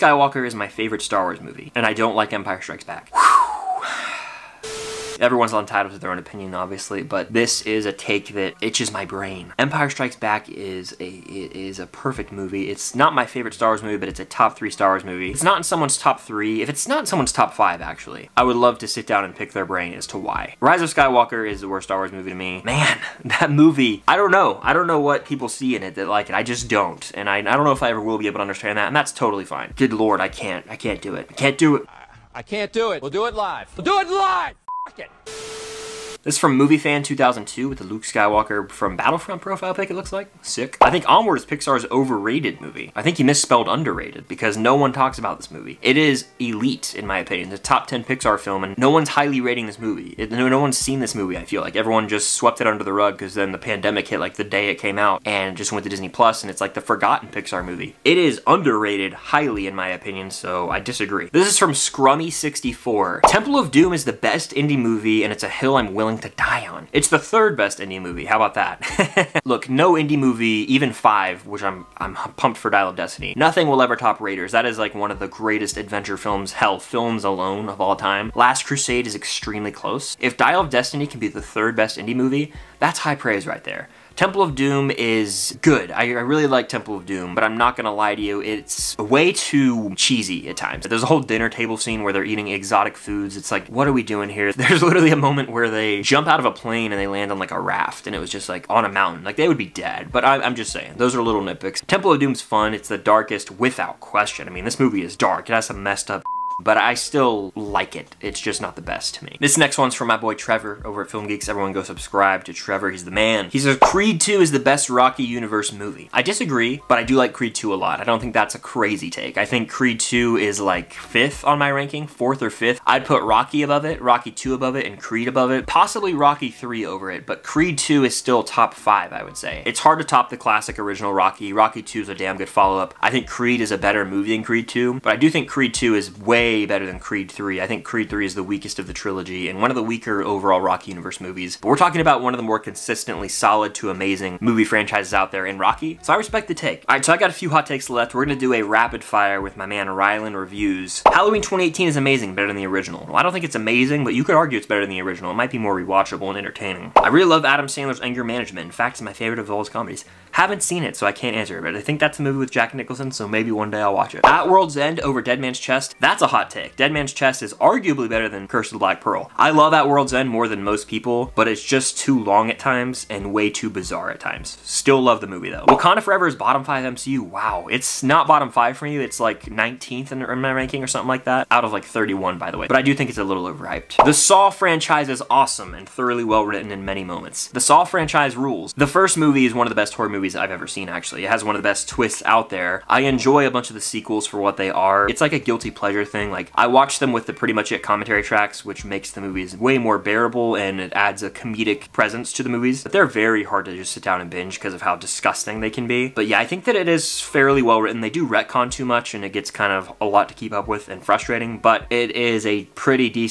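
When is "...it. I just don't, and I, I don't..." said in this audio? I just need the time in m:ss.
0:26.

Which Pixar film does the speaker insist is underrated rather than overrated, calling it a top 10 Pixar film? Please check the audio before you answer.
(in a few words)
Onward.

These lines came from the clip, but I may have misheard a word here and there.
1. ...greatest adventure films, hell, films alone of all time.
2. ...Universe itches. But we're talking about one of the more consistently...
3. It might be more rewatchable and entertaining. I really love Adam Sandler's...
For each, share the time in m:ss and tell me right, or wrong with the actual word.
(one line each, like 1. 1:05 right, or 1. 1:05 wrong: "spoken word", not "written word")
1. 1:15 right
2. 2:20 wrong: "movies", not "itches"
3. 2:35 right.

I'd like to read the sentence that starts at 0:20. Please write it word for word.
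Rise of Skywalker is the worst Star Wars movie to me.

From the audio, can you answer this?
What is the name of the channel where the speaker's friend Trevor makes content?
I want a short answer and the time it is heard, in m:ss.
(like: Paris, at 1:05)
Film Geeks, at 1:51.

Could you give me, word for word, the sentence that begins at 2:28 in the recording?
We're gonna do a rapid fire with my man Rylan Reviews.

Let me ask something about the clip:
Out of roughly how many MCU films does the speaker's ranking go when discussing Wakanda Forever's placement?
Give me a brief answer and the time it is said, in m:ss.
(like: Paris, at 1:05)
31, at 3:01.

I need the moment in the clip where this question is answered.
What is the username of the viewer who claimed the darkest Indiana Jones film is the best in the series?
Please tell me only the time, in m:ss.
1:01.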